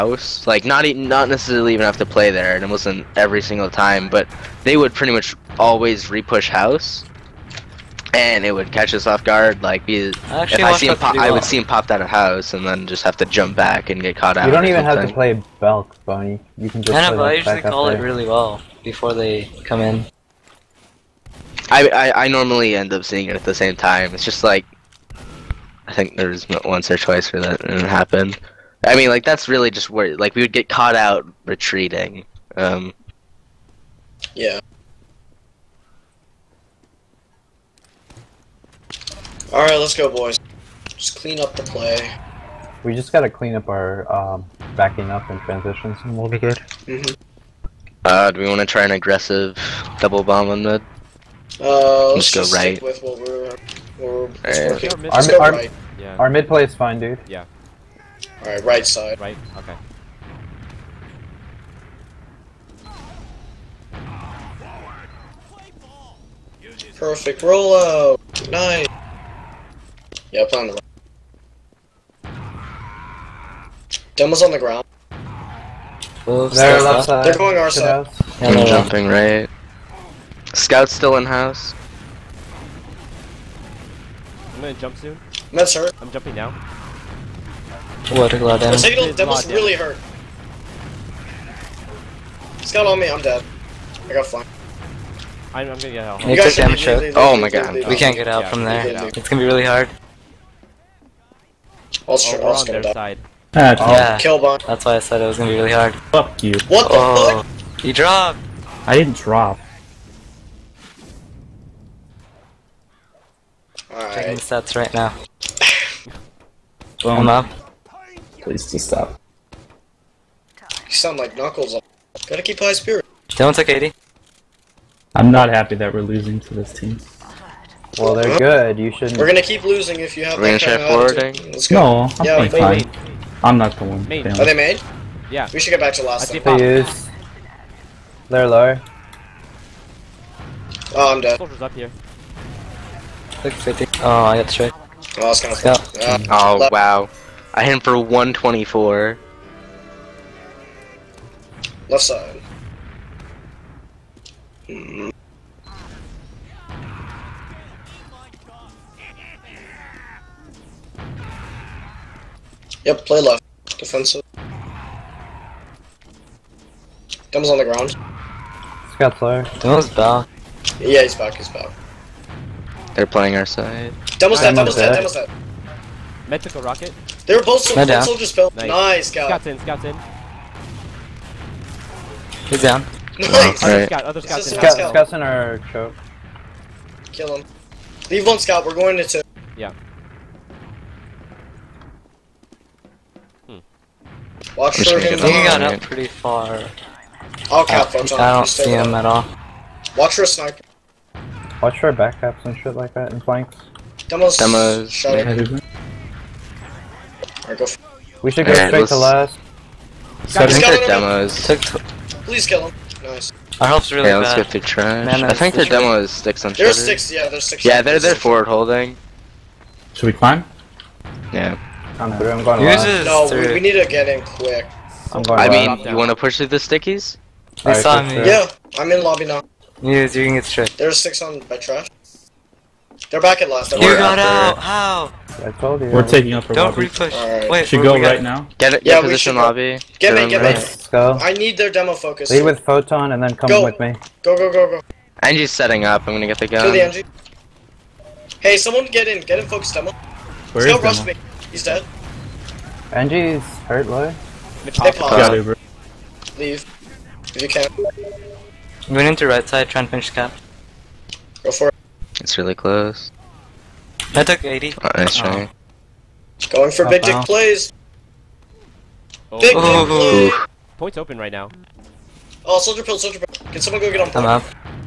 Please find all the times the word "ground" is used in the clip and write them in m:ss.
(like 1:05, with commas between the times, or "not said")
1:14, 2:47.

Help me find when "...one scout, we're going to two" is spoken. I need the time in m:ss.
3:08.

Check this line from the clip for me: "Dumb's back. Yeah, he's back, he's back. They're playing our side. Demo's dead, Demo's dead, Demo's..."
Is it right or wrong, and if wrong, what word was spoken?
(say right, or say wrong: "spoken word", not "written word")
right.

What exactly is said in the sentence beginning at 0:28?
I mean, like that's really just where like we would get caught out retreating.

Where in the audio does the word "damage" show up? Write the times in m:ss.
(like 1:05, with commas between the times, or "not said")
1:36.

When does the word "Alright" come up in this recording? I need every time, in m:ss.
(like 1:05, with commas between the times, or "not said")
0:58, 1:53.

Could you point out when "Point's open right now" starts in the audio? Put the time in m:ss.
4:30.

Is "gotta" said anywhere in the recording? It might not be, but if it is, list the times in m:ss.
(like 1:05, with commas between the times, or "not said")
0:43, 2:02.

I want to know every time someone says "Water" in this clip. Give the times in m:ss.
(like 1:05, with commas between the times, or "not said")
1:28.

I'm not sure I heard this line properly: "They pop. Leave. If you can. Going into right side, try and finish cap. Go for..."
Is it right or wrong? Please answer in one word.
right.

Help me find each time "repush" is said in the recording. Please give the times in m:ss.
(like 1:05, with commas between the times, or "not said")
0:06, 3:56.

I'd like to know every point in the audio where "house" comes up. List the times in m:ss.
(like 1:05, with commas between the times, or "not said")
0:06, 0:12, 1:21.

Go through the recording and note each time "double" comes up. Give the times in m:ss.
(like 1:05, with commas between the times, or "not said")
0:49.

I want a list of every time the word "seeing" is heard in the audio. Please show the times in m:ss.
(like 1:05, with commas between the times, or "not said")
0:23.